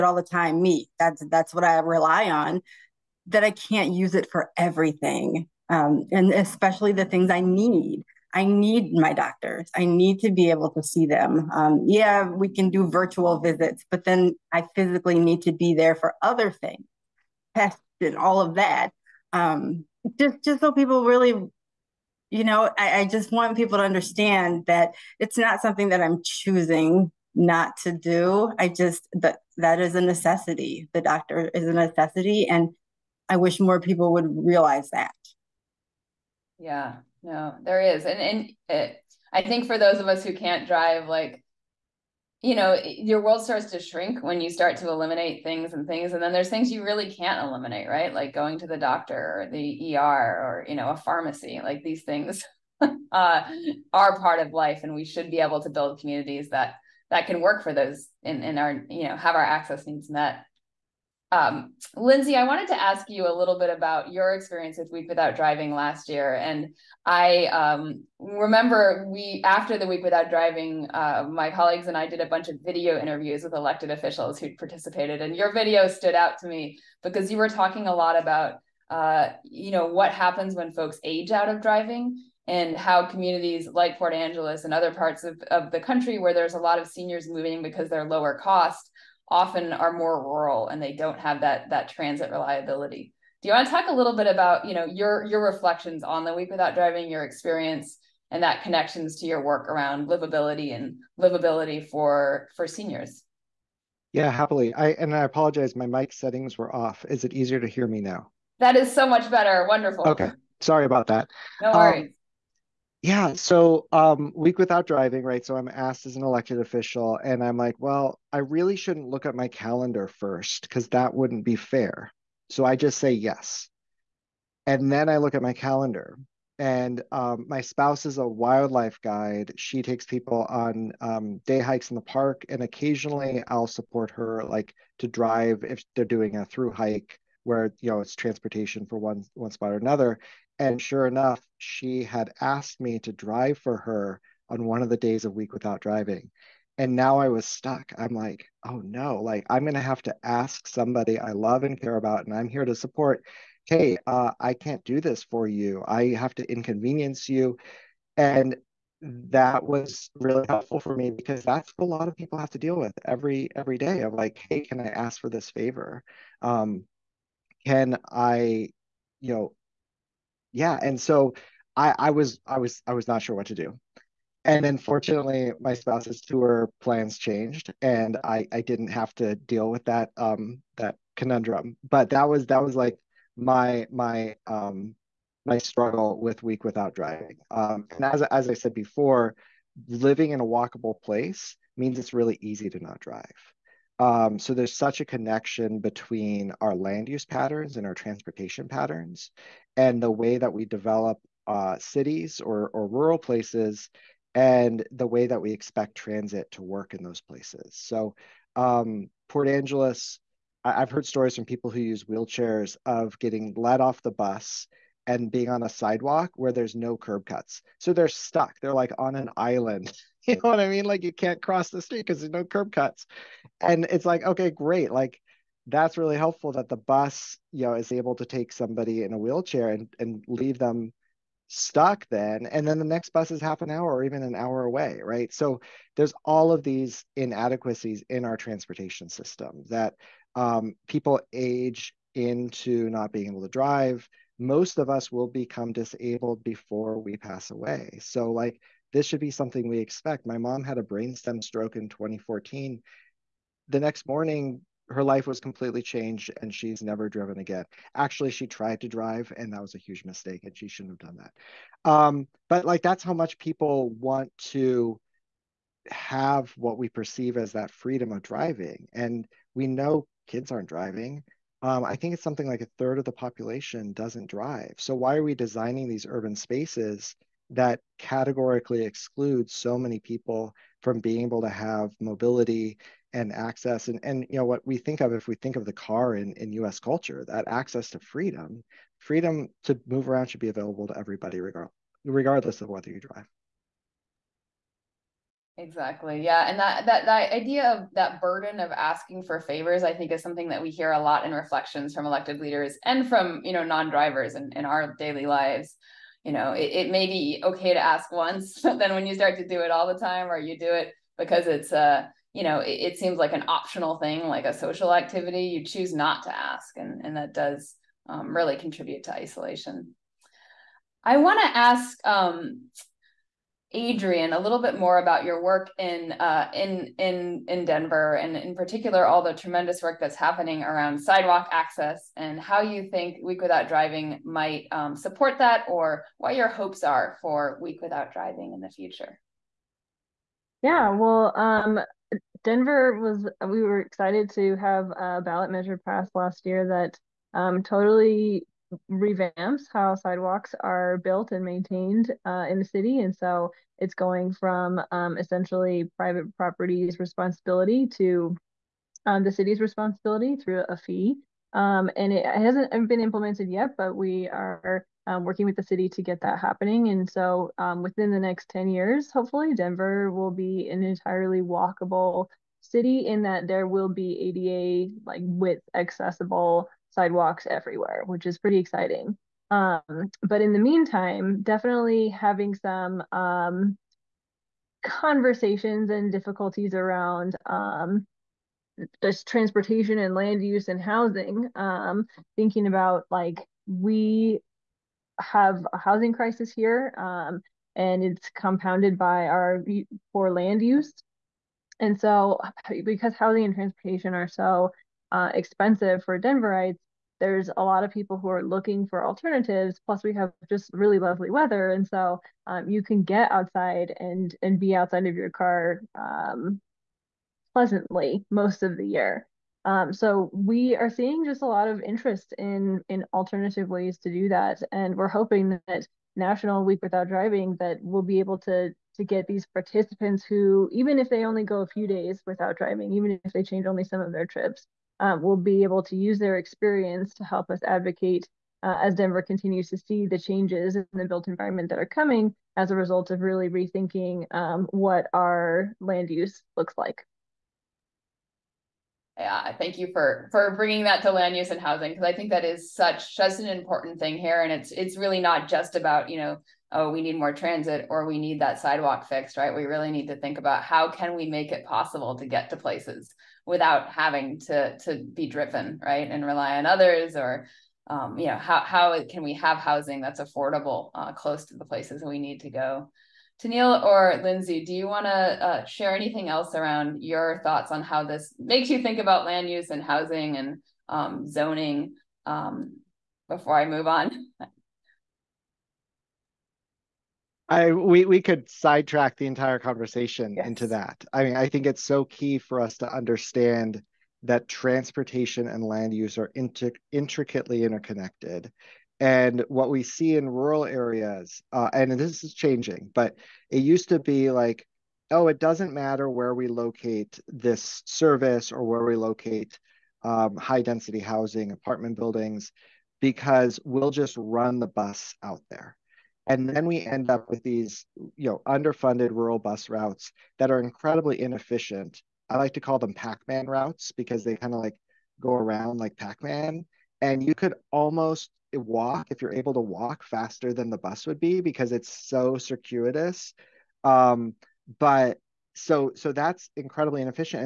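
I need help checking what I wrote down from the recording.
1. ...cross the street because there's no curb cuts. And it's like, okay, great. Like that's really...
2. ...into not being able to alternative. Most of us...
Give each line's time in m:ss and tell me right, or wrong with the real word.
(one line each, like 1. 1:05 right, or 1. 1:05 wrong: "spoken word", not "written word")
1. 3:41 right
2. 4:02 wrong: "drive", not "alternative".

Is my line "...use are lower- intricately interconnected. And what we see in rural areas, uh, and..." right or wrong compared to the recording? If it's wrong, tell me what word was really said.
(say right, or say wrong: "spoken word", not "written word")
wrong: "inter", not "lower".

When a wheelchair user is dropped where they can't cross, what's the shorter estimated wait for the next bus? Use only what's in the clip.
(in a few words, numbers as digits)
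Half an hour.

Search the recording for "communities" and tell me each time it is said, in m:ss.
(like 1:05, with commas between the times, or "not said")
0:55, 1:23.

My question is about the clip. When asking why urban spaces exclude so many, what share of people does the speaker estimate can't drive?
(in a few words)
A third.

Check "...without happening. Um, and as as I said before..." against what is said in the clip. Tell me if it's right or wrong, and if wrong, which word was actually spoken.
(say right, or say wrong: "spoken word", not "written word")
wrong: "driving", not "happening".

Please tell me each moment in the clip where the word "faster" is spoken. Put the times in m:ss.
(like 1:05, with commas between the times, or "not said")
8:50.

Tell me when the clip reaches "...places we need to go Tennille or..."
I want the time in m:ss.
7:51.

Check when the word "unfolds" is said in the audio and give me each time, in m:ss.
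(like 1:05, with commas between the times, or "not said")
not said.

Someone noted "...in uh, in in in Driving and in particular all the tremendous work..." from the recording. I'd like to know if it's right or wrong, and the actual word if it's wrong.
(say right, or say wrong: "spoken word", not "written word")
wrong: "Denver", not "Driving".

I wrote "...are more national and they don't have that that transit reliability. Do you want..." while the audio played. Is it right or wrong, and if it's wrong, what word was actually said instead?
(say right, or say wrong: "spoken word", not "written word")
wrong: "rural", not "national".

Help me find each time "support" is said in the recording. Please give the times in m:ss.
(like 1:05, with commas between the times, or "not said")
2:13, 2:32, 5:34.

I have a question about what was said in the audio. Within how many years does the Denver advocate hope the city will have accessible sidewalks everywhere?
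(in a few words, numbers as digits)
10 years.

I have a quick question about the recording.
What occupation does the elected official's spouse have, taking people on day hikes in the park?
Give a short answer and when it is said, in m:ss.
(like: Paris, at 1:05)
Wildlife guide, at 2:08.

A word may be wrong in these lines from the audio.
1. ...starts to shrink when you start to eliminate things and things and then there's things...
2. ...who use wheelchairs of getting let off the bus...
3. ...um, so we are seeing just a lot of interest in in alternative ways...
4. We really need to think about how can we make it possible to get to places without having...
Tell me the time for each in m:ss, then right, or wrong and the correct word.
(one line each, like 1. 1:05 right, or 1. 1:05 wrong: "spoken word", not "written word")
1. 0:43 right
2. 3:31 right
3. 6:59 right
4. 7:39 right.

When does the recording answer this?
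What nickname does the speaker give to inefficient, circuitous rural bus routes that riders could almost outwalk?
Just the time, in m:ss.
8:42.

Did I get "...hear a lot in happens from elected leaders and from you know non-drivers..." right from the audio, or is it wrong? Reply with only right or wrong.
wrong.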